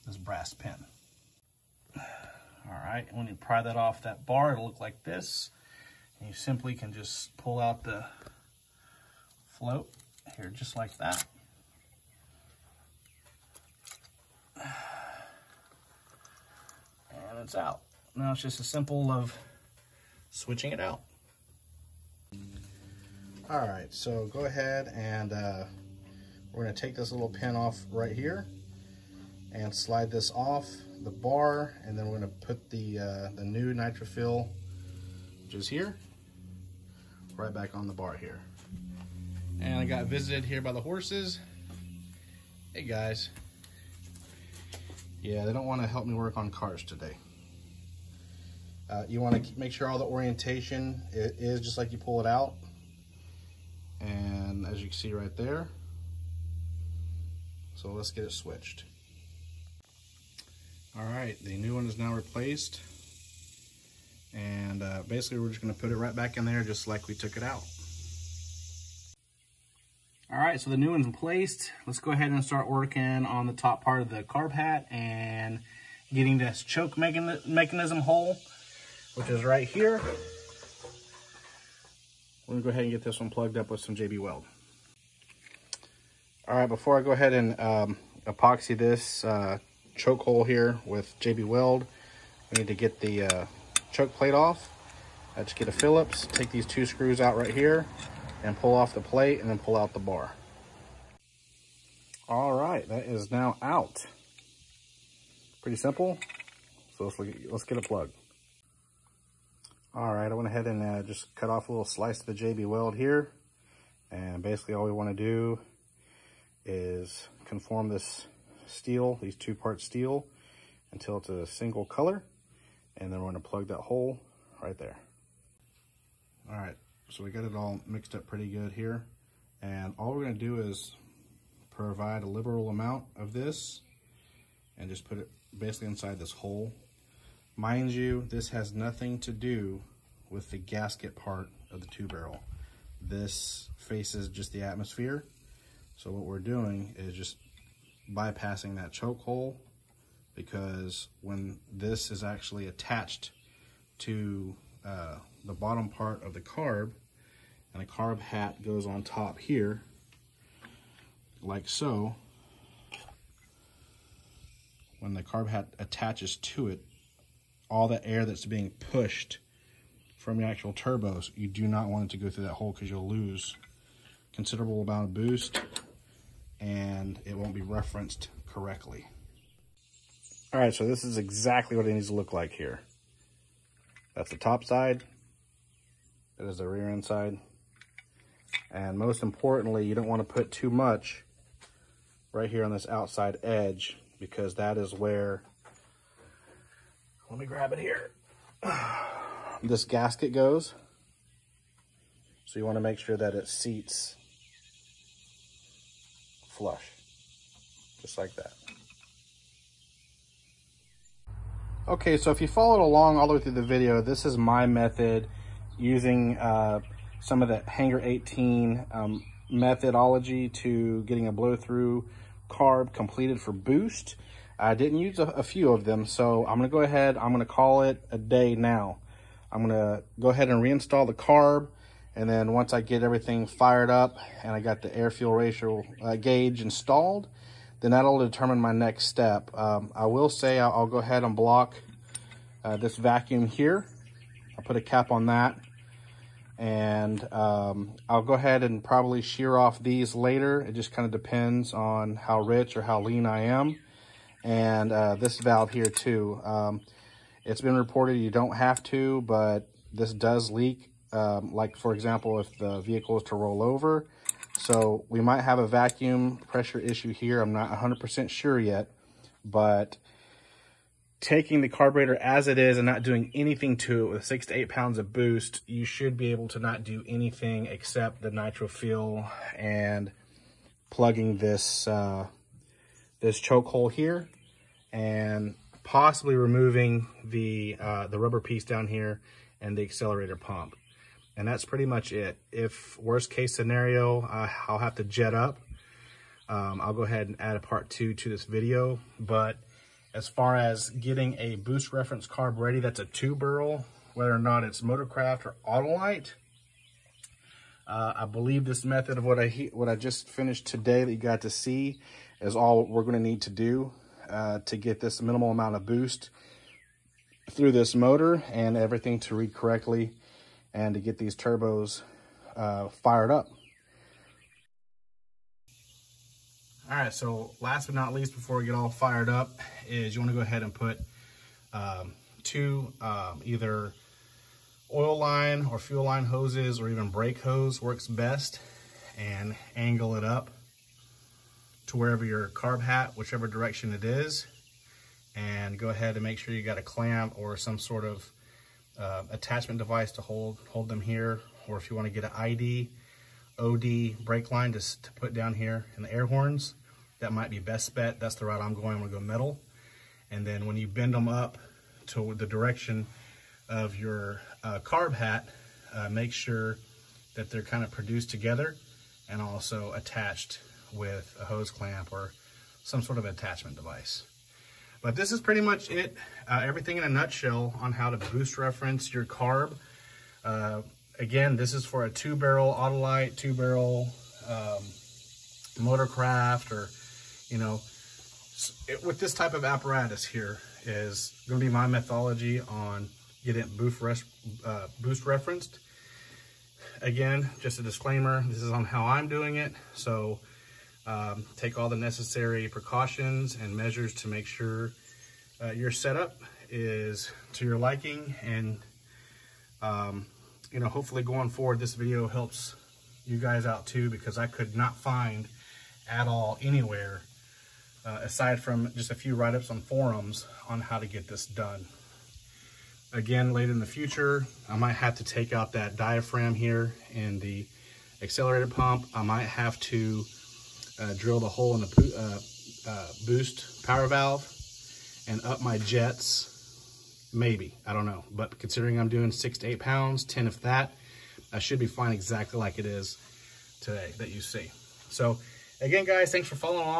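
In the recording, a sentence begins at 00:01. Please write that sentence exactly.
All right, when you pry that off that bar, it'll look like this.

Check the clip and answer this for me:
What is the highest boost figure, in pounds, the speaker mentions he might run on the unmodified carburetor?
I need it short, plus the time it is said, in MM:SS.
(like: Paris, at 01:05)
10, at 07:20.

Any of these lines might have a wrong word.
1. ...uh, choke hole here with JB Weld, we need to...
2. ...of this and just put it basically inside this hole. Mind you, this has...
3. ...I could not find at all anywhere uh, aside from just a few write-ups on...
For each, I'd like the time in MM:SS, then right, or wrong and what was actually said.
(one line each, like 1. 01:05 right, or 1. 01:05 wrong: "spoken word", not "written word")
1. 01:29 right
2. 02:13 right
3. 06:54 right.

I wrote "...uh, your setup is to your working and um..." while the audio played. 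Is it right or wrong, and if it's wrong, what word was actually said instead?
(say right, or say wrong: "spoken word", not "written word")
wrong: "liking", not "working".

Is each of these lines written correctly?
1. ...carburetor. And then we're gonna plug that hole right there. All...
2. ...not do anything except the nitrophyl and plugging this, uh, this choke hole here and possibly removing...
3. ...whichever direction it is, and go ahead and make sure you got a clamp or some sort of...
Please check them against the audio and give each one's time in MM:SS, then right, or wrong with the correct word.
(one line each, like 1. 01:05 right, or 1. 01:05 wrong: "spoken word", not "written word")
1. 02:01 wrong: "color", not "carburetor"
2. 04:36 right
3. 05:43 right.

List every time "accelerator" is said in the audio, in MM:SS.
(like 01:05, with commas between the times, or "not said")
04:49, 07:08.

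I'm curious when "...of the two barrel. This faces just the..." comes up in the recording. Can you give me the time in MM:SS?
02:21.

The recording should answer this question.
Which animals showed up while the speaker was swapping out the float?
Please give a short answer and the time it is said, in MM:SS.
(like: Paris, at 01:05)
horses, at 00:40.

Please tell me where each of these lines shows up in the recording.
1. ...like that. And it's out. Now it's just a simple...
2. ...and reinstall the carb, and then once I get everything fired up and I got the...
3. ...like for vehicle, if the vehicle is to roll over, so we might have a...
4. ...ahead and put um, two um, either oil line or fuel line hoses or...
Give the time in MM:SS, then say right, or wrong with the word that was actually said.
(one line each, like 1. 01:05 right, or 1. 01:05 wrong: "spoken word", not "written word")
1. 00:10 right
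2. 03:50 right
3. 04:21 wrong: "example", not "vehicle"
4. 05:30 right.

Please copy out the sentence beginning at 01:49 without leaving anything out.
All right, I went ahead and uh, just cut off a little slice of the JB Weld here.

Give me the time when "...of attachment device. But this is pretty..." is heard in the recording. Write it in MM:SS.
06:13.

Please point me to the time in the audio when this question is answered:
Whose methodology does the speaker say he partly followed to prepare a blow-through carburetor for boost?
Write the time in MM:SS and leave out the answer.
03:37.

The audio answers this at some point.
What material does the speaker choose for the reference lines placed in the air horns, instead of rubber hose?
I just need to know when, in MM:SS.
05:59.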